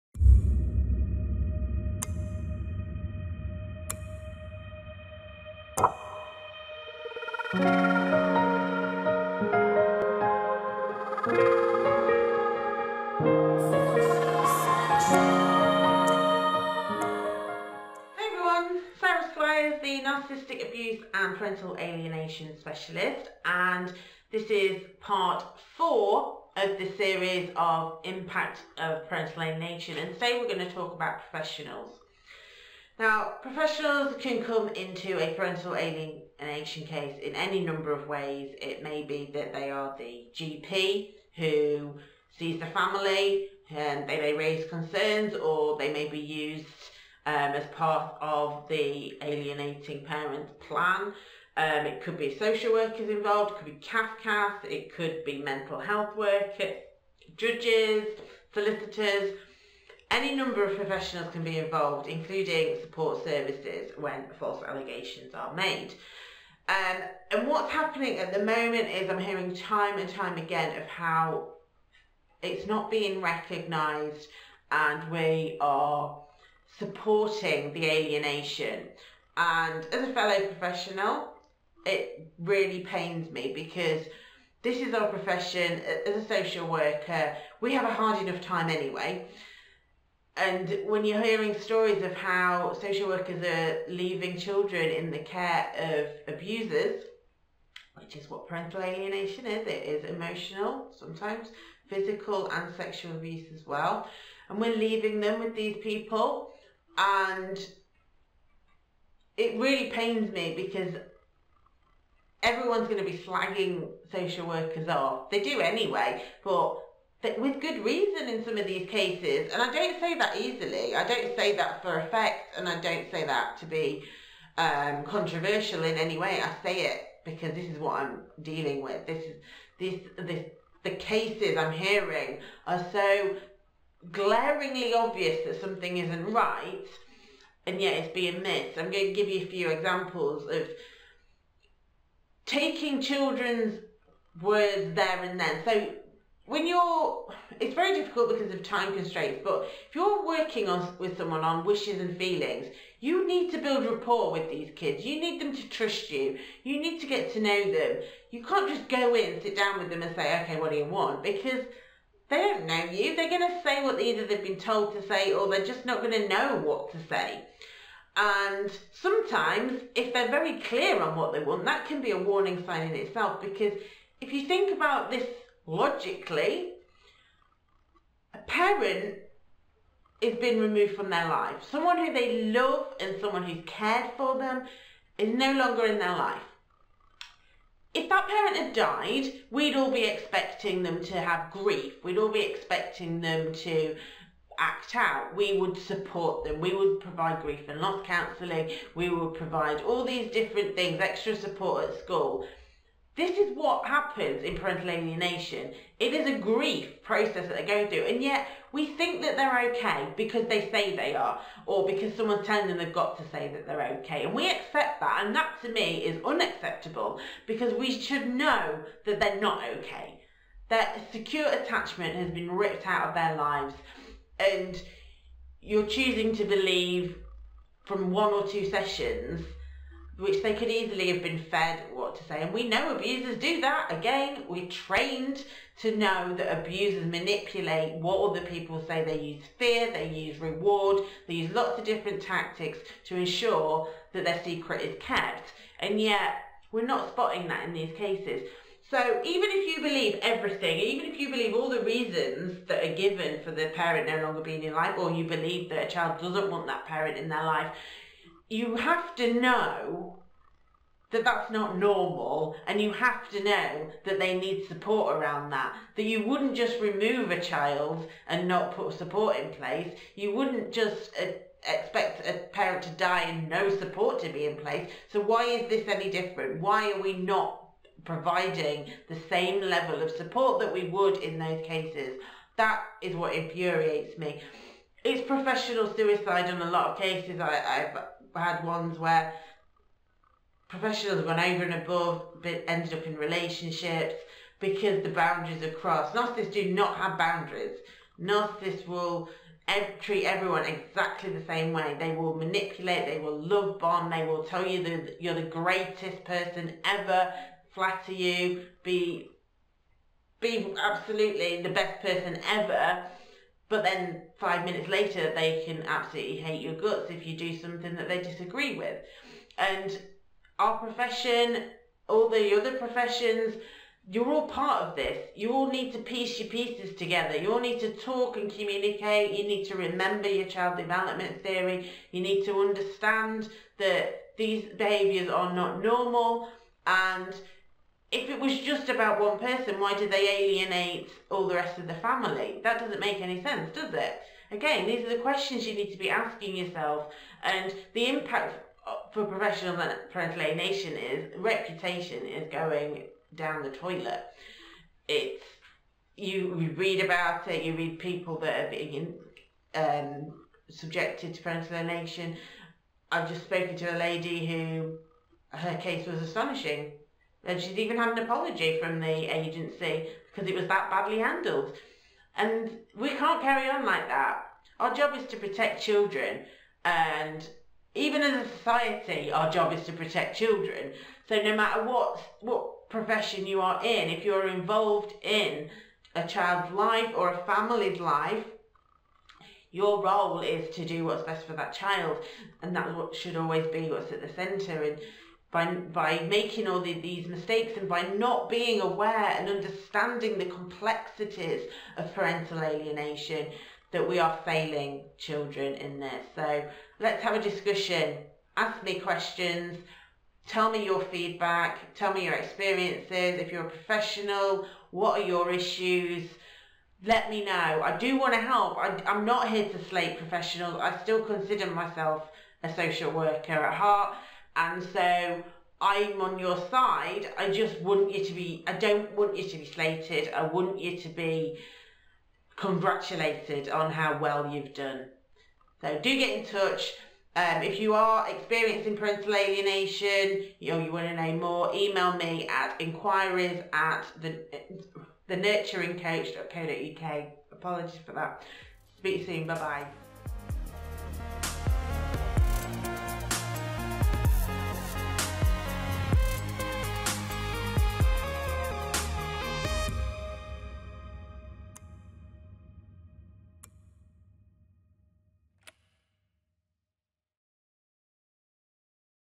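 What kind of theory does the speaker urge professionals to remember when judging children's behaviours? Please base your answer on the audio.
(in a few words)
Child development theory.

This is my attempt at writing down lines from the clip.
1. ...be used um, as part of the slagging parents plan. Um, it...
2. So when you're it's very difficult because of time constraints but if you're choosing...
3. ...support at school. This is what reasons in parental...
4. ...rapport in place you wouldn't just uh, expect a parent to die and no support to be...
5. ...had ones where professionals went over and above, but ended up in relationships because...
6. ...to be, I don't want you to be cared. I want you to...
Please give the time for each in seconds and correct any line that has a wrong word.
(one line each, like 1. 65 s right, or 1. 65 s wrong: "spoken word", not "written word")
1. 46 s wrong: "alienating", not "slagging"
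2. 145 s wrong: "working", not "choosing"
3. 201 s wrong: "happens", not "reasons"
4. 268 s wrong: "support", not "rapport"
5. 288 s right
6. 428 s wrong: "slated", not "cared".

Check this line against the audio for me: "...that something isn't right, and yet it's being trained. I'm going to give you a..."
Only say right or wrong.
wrong.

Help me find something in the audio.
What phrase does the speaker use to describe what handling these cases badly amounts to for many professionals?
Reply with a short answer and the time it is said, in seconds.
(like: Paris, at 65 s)
Professional suicide, at 285 s.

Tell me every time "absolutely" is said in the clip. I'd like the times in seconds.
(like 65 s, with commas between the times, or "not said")
310 s, 315 s.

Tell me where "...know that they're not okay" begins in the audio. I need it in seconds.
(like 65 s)
218 s.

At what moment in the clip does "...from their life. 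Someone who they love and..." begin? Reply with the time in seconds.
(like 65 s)
180 s.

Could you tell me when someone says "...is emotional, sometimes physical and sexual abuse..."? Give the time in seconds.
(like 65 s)
99 s.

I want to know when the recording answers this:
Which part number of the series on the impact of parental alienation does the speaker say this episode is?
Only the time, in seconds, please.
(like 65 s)
25 s.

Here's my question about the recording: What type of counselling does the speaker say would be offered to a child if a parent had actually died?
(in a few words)
Grief and loss counselling.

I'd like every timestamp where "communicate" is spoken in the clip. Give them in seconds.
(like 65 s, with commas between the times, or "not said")
328 s.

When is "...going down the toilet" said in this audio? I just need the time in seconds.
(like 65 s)
352 s.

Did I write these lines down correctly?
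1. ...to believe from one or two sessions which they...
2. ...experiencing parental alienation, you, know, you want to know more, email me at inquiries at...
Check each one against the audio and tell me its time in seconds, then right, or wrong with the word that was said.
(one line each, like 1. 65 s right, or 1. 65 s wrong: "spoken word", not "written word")
1. 226 s right
2. 438 s right.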